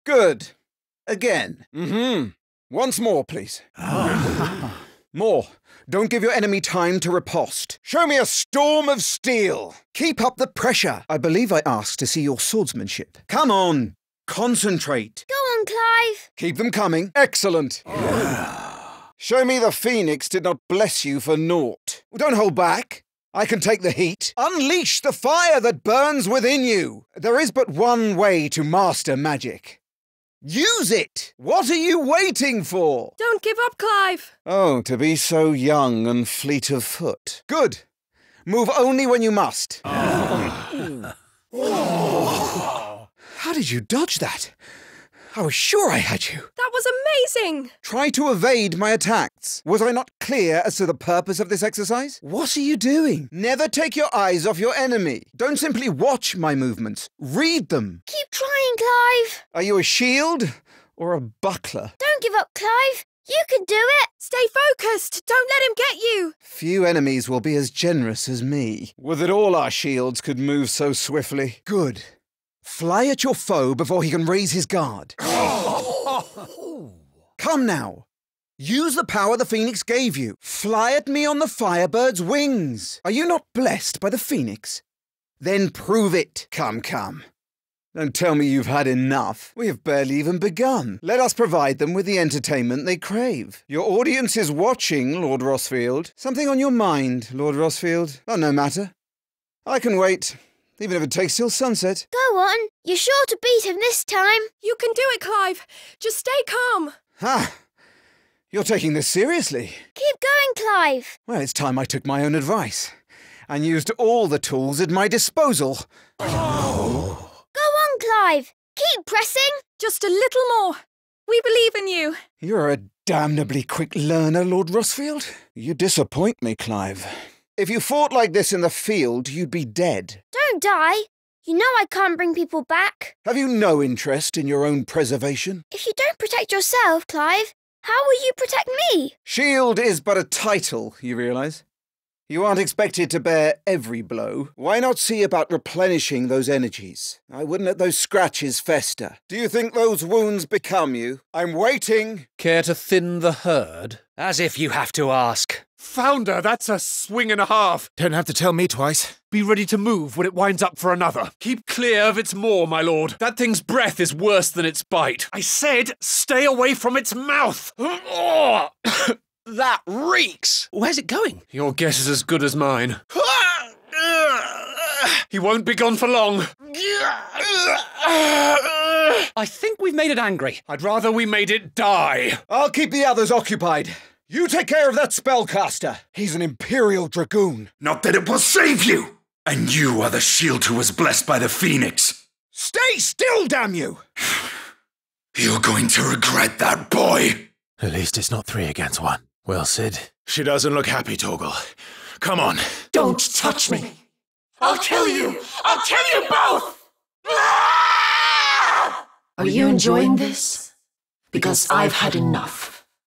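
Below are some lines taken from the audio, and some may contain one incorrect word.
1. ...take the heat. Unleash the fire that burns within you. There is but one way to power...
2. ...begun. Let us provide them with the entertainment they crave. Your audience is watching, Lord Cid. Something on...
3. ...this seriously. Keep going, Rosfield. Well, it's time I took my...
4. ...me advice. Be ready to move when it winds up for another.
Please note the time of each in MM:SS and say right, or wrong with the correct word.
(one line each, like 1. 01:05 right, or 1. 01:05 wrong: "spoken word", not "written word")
1. 00:23 wrong: "master", not "power"
2. 01:30 wrong: "Rosfield", not "Cid"
3. 01:48 wrong: "Clive", not "Rosfield"
4. 02:38 wrong: "twice", not "advice".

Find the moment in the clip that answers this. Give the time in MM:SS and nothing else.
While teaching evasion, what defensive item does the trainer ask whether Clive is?
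01:01.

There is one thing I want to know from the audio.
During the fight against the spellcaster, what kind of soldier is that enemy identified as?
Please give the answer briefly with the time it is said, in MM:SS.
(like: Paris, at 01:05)
Imperial Dragoon, at 03:06.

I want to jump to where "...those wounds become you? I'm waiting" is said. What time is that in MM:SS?
02:29.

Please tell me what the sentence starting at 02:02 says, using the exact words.
You're a damnably quick learner, Lord Rosfield.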